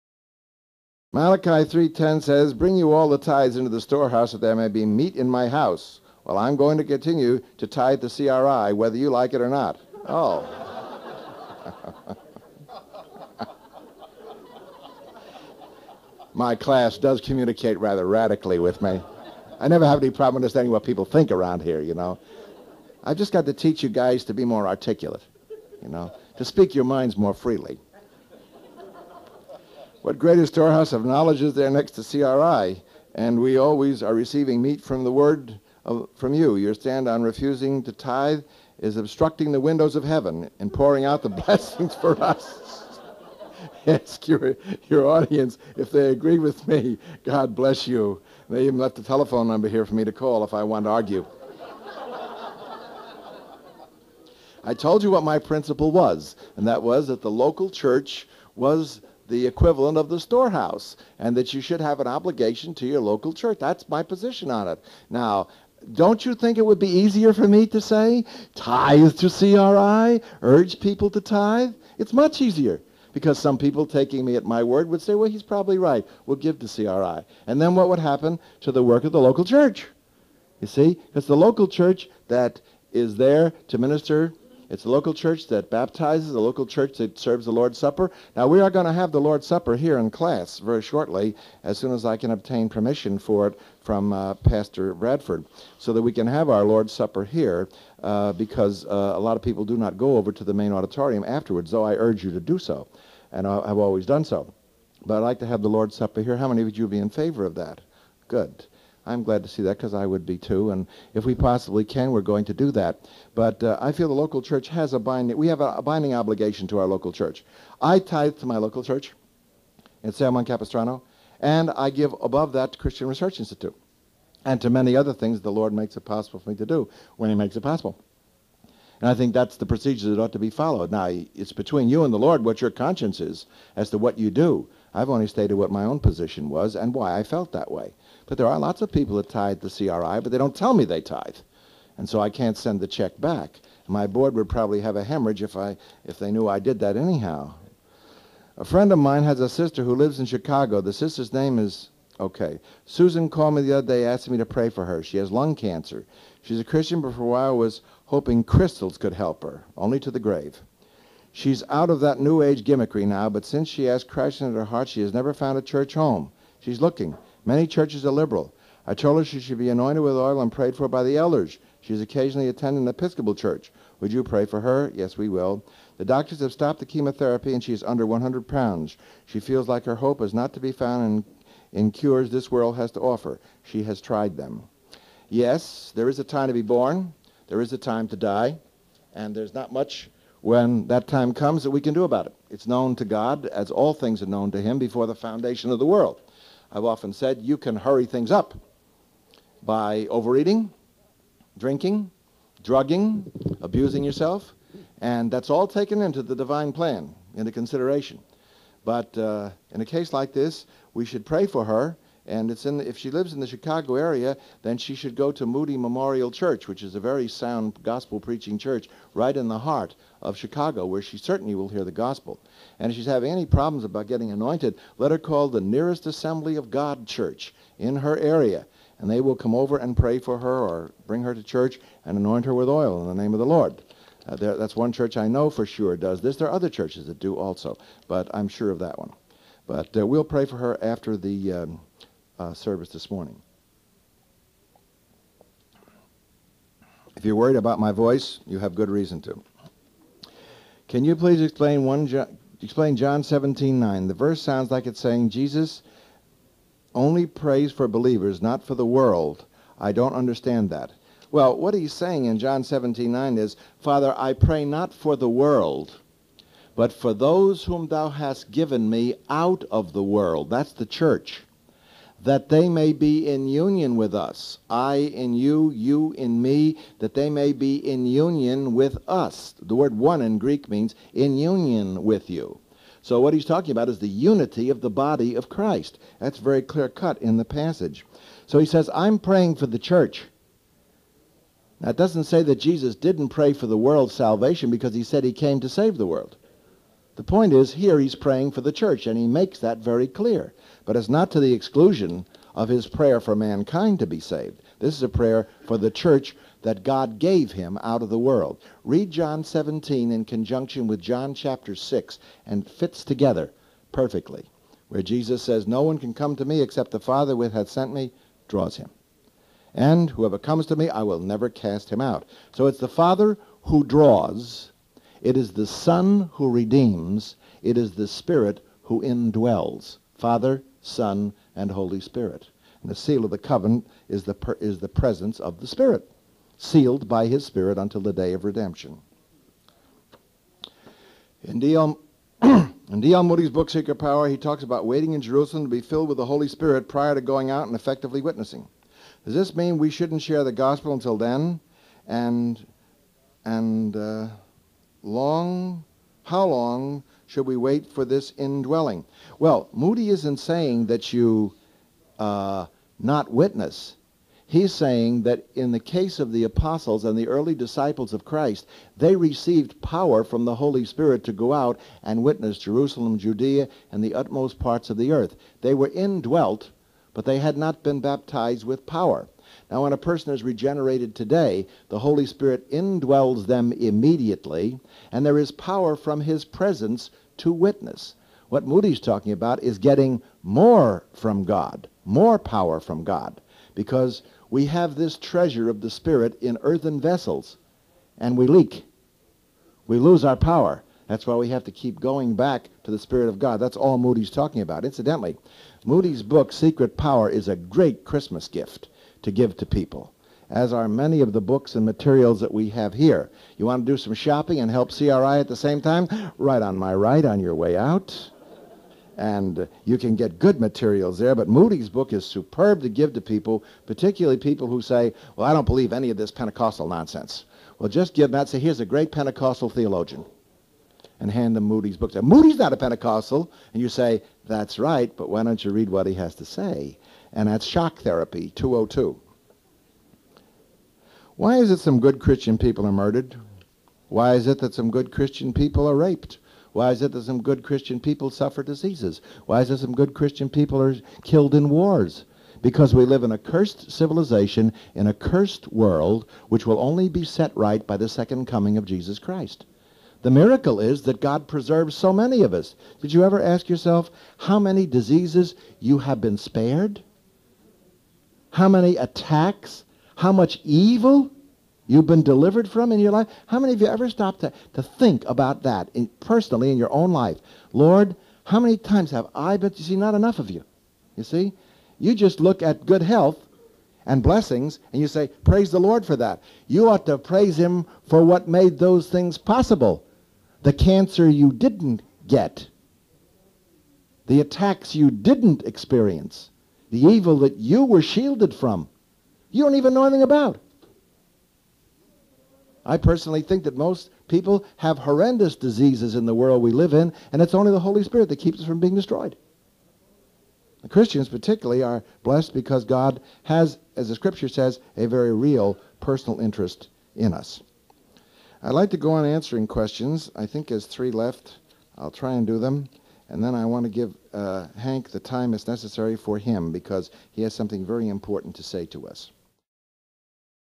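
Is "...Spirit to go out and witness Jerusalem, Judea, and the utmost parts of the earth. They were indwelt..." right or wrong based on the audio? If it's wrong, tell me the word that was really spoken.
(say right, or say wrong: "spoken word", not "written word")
right.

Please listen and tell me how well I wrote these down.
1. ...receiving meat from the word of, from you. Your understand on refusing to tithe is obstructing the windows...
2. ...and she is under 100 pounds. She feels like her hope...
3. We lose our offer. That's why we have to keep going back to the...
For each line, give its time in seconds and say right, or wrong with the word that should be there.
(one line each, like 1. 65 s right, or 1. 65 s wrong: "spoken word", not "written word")
1. 34 s wrong: "stand", not "understand"
2. 177 s right
3. 399 s wrong: "power", not "offer".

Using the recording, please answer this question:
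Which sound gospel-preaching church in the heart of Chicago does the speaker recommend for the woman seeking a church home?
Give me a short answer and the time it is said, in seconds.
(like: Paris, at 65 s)
Moody Memorial Church, at 215 s.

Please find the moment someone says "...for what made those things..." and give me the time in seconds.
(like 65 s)
488 s.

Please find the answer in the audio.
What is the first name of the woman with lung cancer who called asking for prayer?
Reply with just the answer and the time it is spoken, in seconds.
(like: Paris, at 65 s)
Susan, at 152 s.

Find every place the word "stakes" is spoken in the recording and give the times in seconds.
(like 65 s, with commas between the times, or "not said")
not said.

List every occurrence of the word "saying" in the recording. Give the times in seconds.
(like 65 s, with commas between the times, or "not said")
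254 s, 261 s, 360 s, 364 s.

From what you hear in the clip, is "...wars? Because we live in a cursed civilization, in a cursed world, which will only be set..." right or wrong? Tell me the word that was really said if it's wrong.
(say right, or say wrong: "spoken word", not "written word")
right.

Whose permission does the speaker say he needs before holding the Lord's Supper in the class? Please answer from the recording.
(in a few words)
Pastor Bradford.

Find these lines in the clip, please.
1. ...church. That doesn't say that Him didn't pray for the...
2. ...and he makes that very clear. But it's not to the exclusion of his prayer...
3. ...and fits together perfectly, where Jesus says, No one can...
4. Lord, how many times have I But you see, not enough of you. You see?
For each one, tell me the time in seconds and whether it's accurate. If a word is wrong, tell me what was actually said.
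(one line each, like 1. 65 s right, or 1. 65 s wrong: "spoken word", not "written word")
1. 289 s wrong: "Jesus", not "Him"
2. 299 s right
3. 312 s right
4. 477 s right.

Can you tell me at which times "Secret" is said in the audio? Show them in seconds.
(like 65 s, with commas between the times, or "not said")
343 s, 406 s.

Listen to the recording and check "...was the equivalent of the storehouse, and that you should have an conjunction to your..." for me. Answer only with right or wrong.
wrong.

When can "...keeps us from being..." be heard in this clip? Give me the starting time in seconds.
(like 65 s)
508 s.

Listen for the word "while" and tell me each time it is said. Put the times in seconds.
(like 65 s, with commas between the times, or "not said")
157 s.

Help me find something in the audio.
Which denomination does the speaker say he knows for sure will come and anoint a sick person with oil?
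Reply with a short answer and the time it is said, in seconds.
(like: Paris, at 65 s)
Assembly of God, at 226 s.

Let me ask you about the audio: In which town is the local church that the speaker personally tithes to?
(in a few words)
San Juan Capistrano.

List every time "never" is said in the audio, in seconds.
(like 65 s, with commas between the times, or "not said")
19 s, 165 s, 321 s.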